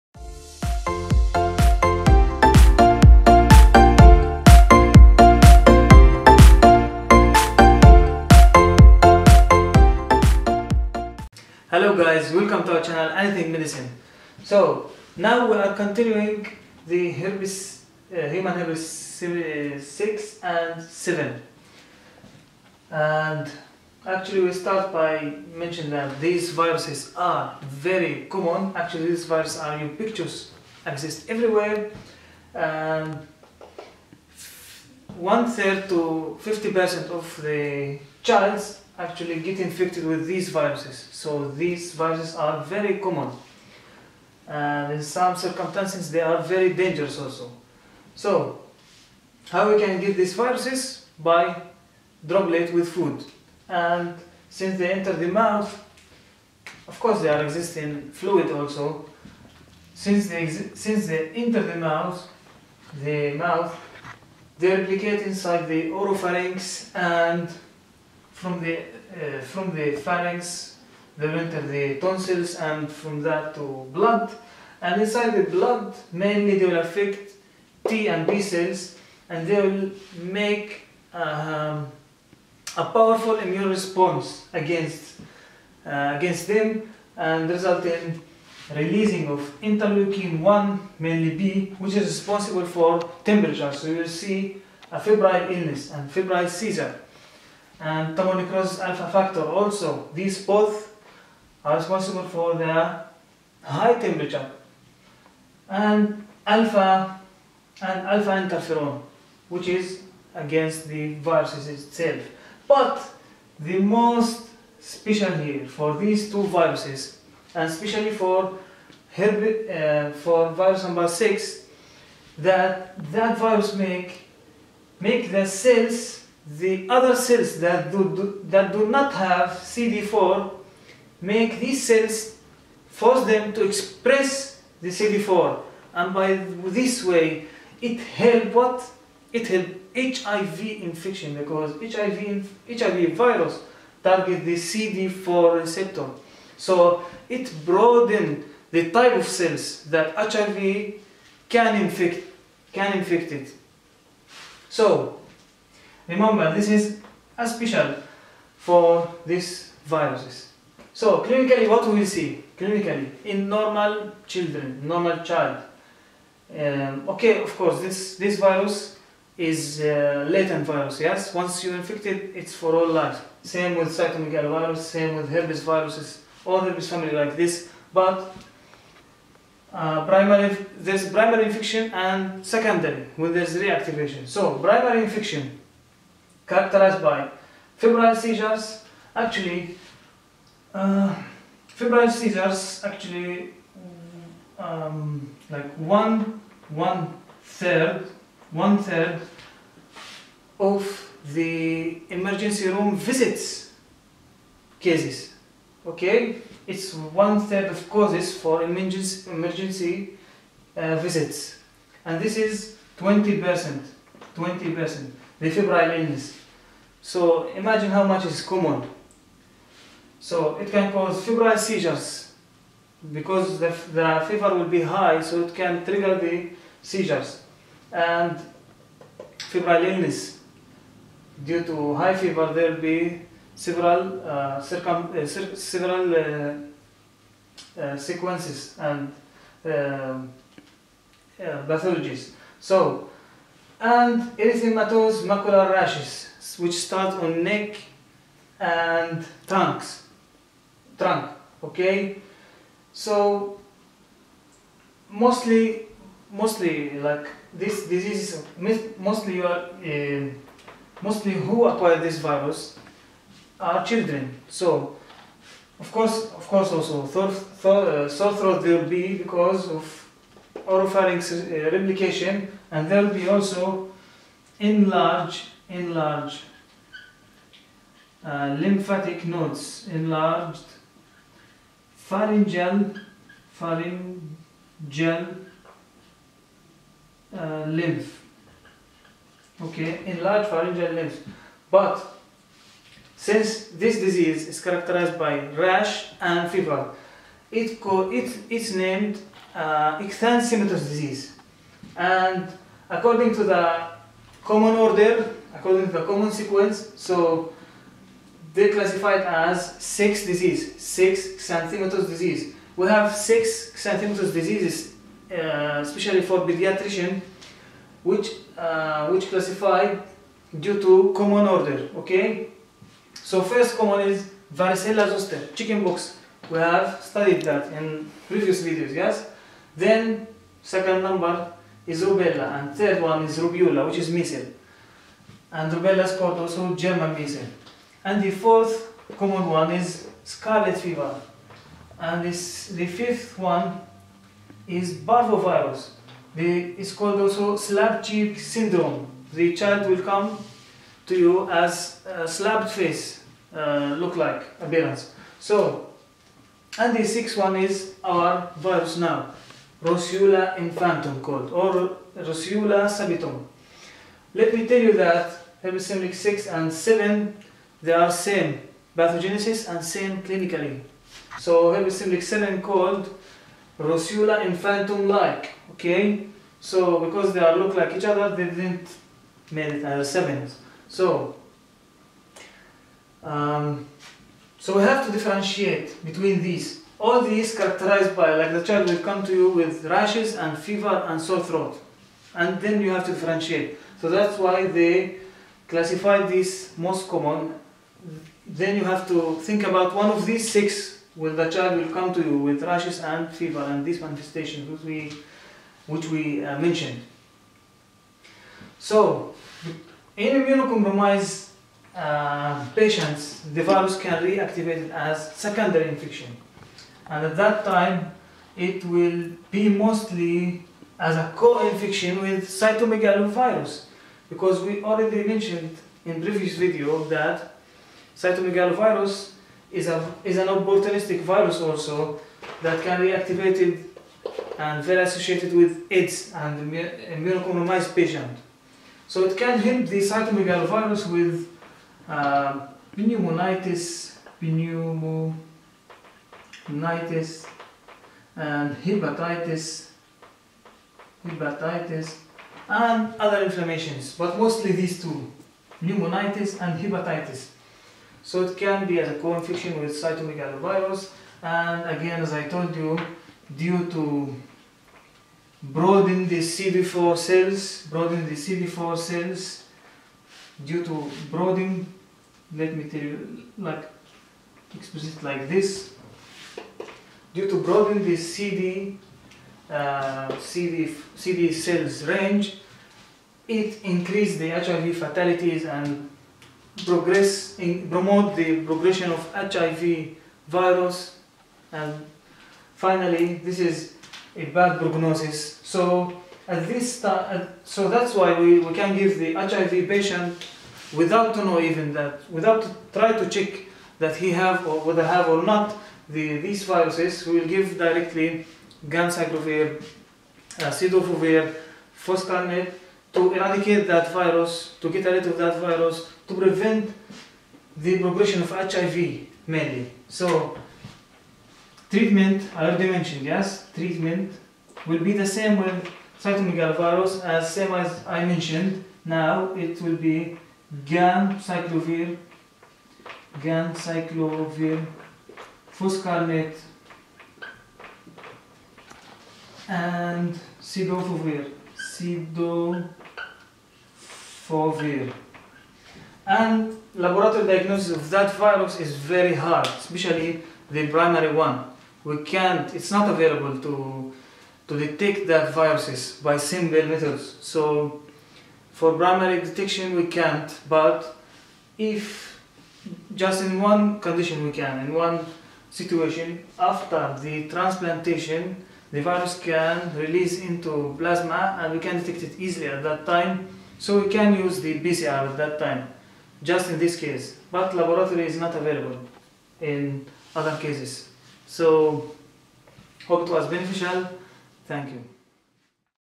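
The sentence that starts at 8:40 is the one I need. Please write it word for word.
So treatment, I already mentioned, yes, treatment will be the same with cytomegalovirus as same as I mentioned.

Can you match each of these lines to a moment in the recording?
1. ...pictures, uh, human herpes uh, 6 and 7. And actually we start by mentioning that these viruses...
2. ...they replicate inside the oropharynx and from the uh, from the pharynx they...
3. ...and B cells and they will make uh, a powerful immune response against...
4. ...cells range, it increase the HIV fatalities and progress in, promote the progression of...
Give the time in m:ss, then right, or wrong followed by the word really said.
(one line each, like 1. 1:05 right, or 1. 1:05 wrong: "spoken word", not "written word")
1. 0:17 wrong: "herpes", not "pictures"
2. 1:04 right
3. 1:18 right
4. 8:01 right.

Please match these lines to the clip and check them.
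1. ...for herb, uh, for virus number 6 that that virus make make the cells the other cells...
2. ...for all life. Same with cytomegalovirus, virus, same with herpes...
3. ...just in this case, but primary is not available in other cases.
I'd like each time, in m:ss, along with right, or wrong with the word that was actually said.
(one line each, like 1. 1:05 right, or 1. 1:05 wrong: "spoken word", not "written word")
1. 1:58 right
2. 2:52 right
3. 9:36 wrong: "laboratory", not "primary".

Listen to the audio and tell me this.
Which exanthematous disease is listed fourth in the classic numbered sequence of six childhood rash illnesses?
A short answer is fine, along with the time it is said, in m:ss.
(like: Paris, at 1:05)
Scarlet fever, at 5:40.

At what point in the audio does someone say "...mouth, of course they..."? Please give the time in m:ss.
0:55.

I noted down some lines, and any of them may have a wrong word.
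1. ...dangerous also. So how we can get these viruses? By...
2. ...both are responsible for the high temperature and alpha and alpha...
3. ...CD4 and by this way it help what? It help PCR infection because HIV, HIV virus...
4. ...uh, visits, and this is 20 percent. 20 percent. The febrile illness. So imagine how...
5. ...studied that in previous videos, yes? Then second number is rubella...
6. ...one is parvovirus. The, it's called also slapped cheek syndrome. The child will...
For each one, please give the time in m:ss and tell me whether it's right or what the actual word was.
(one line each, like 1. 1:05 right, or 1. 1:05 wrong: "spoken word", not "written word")
1. 0:46 right
2. 1:40 right
3. 2:14 wrong: "HIV", not "PCR"
4. 3:30 right
5. 5:27 right
6. 5:43 right.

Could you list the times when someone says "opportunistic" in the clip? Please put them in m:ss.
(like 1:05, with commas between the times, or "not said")
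7:10.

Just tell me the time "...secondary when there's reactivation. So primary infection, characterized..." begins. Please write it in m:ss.
3:02.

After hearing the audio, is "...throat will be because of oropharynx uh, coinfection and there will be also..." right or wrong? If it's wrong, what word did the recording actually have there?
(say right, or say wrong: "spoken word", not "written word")
wrong: "replication", not "coinfection".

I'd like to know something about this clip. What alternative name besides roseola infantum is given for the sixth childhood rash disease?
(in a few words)
Roseola subitum.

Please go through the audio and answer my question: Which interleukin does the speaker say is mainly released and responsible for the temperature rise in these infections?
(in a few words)
Interleukin 1 B.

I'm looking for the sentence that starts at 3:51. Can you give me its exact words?
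Due to high fever there will be several, uh, circum uh, several uh, uh, sequences and um, uh, pathologies.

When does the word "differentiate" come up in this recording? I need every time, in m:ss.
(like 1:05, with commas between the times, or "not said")
6:25, 6:33.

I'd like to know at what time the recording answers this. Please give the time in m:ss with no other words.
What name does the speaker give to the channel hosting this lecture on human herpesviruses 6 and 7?
0:13.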